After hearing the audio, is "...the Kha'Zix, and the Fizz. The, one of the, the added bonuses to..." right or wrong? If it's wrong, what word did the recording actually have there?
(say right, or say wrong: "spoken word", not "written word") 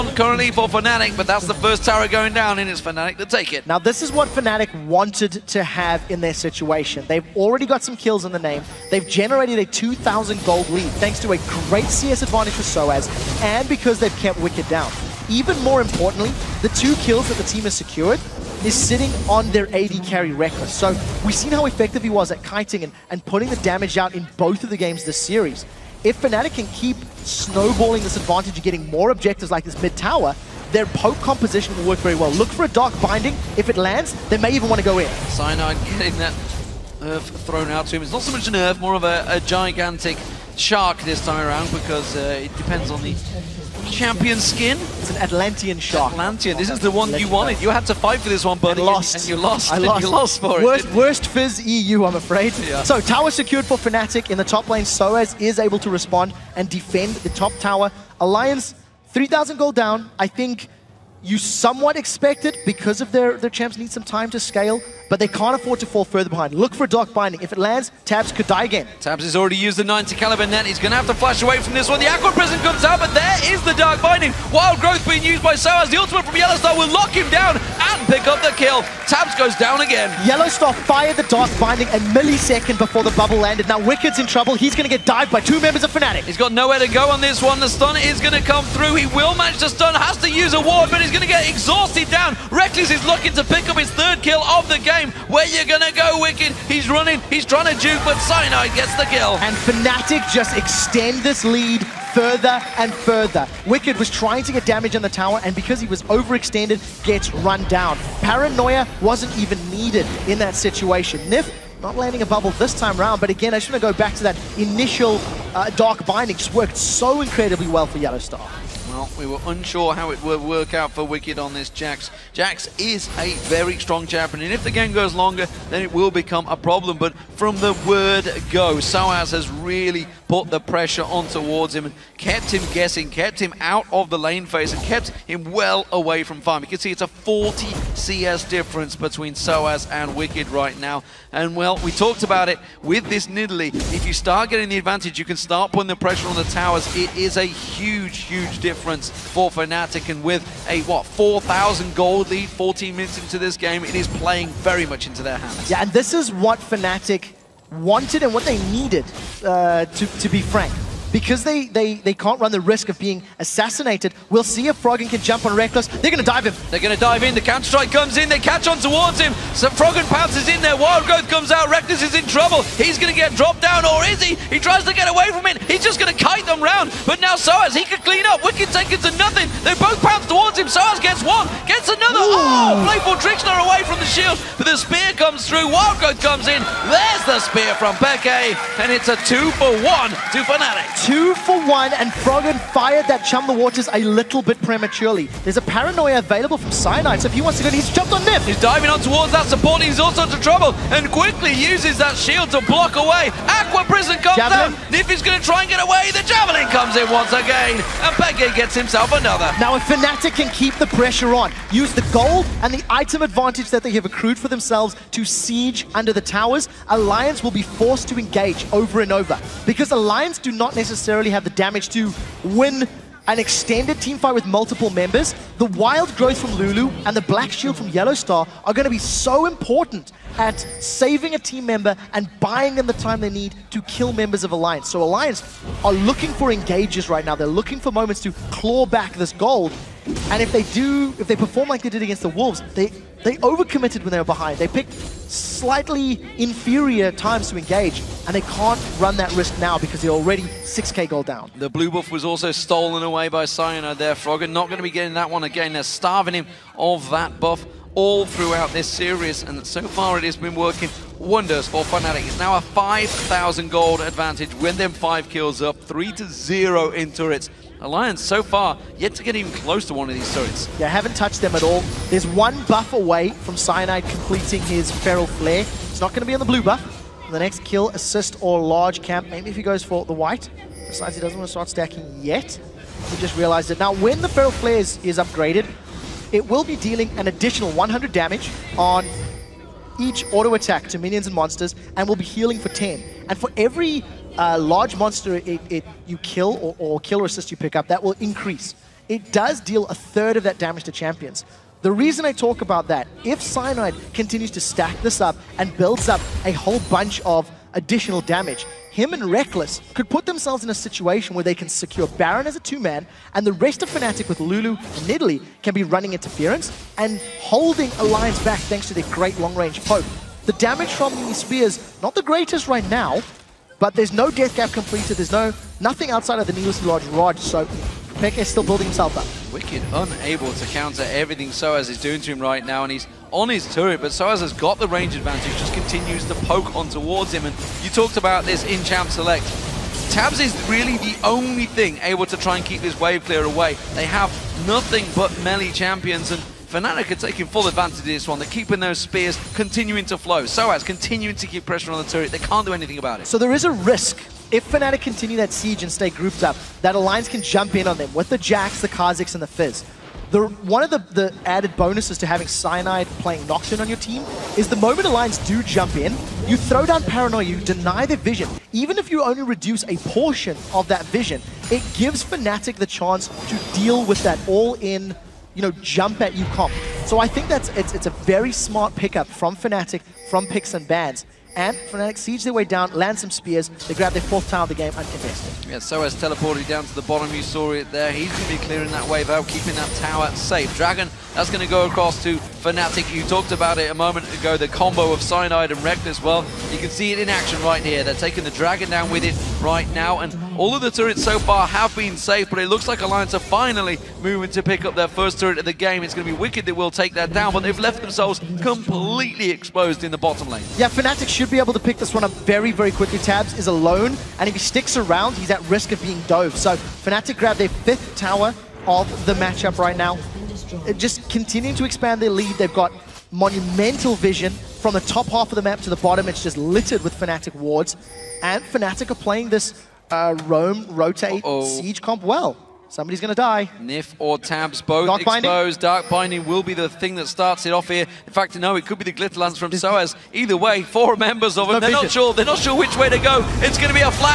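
right.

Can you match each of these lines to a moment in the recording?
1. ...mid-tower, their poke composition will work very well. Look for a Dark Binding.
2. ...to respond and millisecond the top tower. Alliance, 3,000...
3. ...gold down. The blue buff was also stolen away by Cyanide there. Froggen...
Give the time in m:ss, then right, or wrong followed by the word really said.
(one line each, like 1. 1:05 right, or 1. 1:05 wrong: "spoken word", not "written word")
1. 0:29 right
2. 0:55 wrong: "defend", not "millisecond"
3. 4:11 right.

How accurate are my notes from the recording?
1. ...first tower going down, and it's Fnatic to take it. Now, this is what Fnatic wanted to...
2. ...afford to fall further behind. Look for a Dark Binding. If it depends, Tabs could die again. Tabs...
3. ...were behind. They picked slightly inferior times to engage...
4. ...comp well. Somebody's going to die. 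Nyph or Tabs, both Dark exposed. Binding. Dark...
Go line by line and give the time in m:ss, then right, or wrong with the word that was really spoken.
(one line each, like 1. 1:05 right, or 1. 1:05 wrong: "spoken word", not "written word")
1. 0:01 right
2. 1:05 wrong: "lands", not "depends"
3. 4:04 right
4. 7:12 right.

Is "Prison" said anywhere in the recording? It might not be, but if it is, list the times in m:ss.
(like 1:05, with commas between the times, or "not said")
1:12, 3:23.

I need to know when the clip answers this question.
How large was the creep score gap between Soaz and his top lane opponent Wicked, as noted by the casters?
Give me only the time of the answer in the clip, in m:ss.
2:17.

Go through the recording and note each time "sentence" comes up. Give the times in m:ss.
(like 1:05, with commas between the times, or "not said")
not said.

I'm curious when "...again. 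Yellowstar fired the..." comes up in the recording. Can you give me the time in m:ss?
1:19.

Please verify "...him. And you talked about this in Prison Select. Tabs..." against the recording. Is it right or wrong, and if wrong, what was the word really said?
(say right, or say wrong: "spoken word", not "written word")
wrong: "Champ", not "Prison".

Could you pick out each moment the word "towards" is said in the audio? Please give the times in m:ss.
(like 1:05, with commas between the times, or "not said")
2:11, 2:48, 3:00, 3:19, 5:36.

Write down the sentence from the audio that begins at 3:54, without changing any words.
So Alliance are looking for engages right now.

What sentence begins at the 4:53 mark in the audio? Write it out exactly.
And for every uh, large monster it, it you kill or, or kill or assist you pick up, that will increase.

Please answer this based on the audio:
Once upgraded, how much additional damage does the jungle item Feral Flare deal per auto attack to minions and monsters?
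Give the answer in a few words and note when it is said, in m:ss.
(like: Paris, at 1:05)
100, at 4:47.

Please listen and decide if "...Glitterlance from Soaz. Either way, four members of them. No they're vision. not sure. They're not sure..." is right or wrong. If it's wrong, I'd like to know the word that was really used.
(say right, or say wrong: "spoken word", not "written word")
right.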